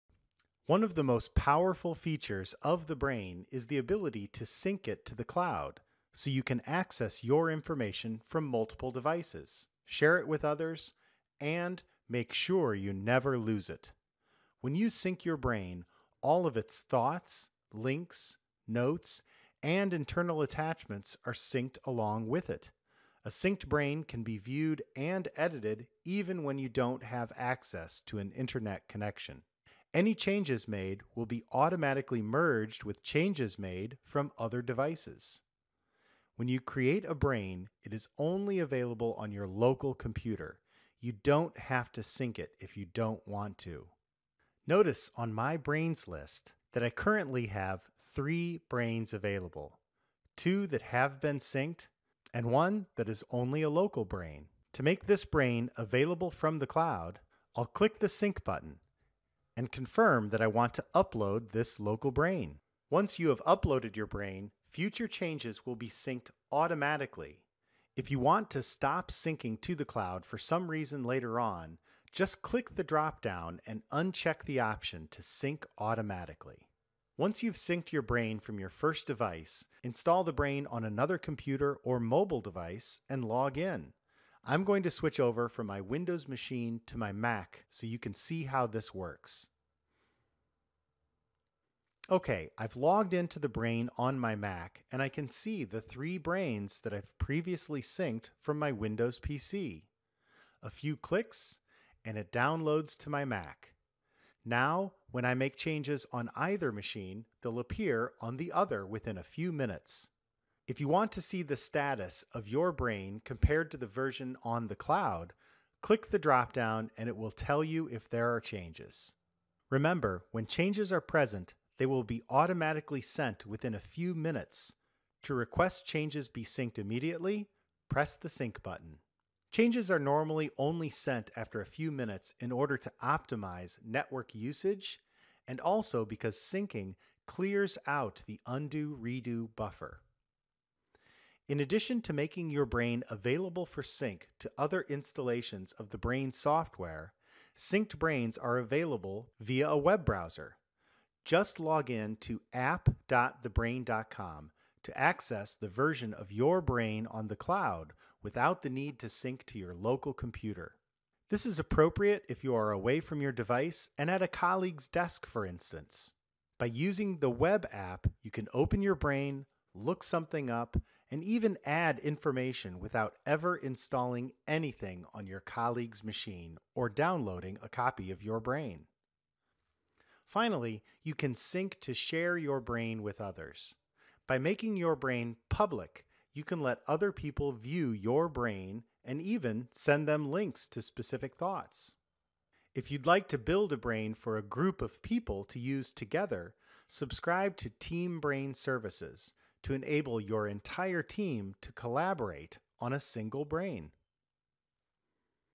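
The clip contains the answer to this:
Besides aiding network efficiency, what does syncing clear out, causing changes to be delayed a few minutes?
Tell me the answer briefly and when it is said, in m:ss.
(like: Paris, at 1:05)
undo redo buffer, at 2:18.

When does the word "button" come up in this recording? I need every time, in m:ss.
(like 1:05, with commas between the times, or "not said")
0:58, 2:08.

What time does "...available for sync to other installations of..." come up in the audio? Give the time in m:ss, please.
2:23.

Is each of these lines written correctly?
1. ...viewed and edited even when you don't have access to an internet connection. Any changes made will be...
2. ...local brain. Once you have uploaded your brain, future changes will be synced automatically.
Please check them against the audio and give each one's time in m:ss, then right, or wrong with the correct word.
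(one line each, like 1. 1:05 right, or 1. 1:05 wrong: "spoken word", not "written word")
1. 0:24 right
2. 1:01 right.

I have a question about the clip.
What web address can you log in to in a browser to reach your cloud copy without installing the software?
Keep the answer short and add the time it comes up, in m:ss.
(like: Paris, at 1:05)
app.thebrain.com, at 2:32.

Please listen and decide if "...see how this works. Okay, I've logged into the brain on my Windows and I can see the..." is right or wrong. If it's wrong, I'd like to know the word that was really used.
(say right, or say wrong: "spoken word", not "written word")
wrong: "Mac", not "Windows".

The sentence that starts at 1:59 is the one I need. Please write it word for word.
Remember, when changes are present, they will be automatically sent within a few minutes.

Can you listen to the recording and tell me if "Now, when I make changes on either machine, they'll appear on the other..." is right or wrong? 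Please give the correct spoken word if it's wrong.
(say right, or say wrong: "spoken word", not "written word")
right.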